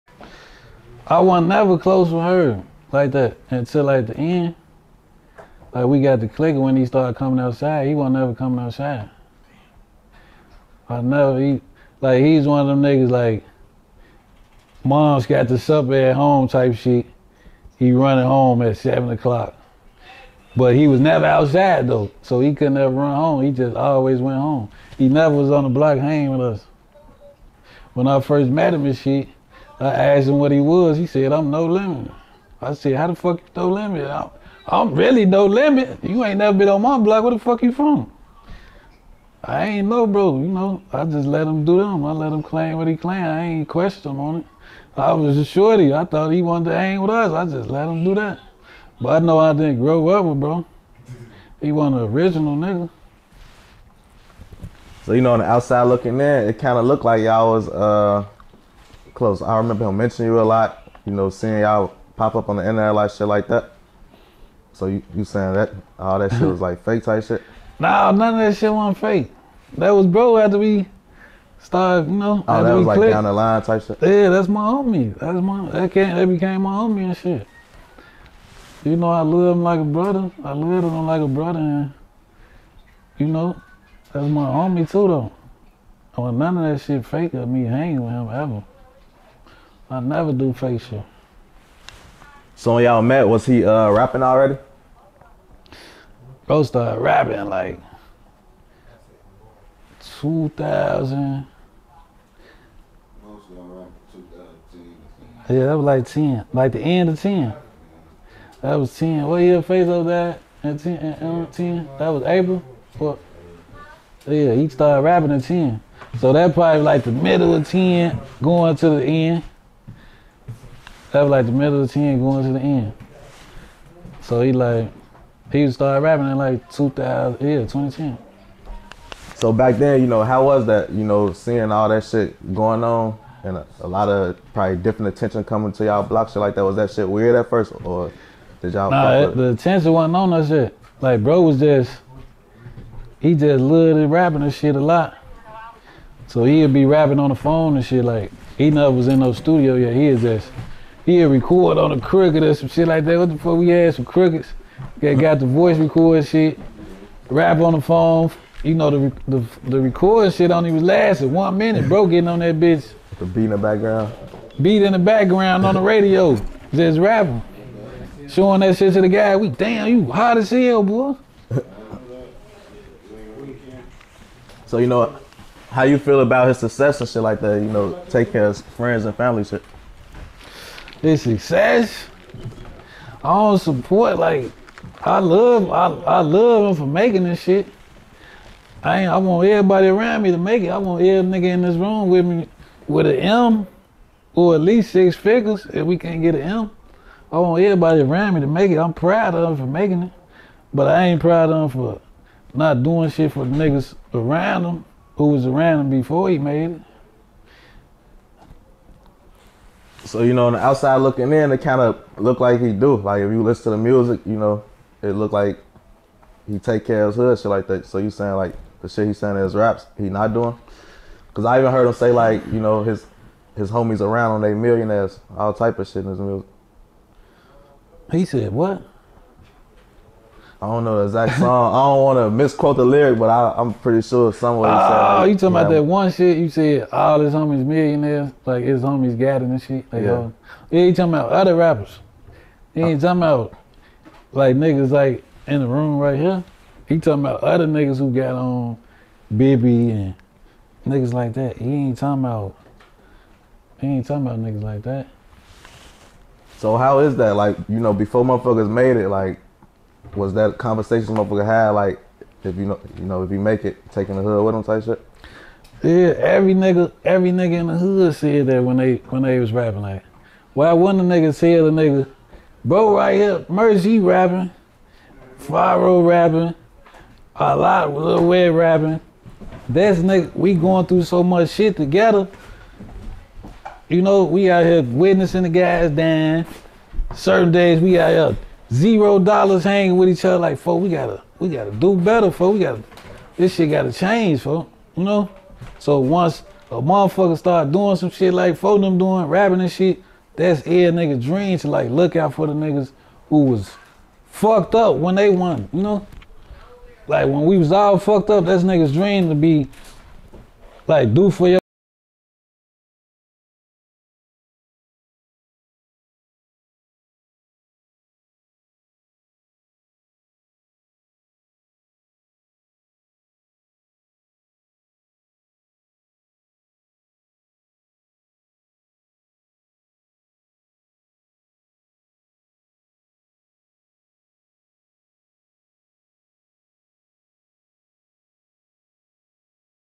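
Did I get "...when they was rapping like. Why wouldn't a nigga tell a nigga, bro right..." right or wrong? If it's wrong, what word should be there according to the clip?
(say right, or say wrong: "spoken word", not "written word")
right.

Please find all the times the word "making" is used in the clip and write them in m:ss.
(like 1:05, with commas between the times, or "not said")
3:06, 3:19.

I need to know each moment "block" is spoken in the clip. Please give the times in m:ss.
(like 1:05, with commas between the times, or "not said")
0:25, 0:36, 2:16.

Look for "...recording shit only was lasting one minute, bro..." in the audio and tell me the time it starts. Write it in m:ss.
2:39.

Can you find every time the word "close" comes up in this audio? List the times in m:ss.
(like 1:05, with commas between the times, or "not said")
0:01, 0:59.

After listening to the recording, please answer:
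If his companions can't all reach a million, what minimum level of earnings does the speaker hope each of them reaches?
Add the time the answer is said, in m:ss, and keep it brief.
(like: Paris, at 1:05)
6 figures, at 3:14.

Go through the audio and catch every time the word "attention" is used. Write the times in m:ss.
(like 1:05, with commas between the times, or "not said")
2:15, 2:19.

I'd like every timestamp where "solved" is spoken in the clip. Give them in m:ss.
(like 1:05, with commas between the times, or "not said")
not said.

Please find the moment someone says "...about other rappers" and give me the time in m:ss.
4:01.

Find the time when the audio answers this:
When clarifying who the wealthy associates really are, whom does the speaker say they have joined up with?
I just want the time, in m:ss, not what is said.
4:09.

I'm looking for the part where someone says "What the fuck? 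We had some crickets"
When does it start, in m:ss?
2:33.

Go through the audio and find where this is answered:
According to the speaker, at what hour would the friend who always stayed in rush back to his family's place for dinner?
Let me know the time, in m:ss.
0:18.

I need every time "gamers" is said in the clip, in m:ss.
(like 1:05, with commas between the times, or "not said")
not said.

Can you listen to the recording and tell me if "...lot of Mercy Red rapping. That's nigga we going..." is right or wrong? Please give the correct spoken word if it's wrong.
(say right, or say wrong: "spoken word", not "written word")
wrong: "Lil", not "Mercy".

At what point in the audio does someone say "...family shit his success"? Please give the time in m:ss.
2:59.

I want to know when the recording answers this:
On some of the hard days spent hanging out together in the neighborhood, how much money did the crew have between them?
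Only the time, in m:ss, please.
4:48.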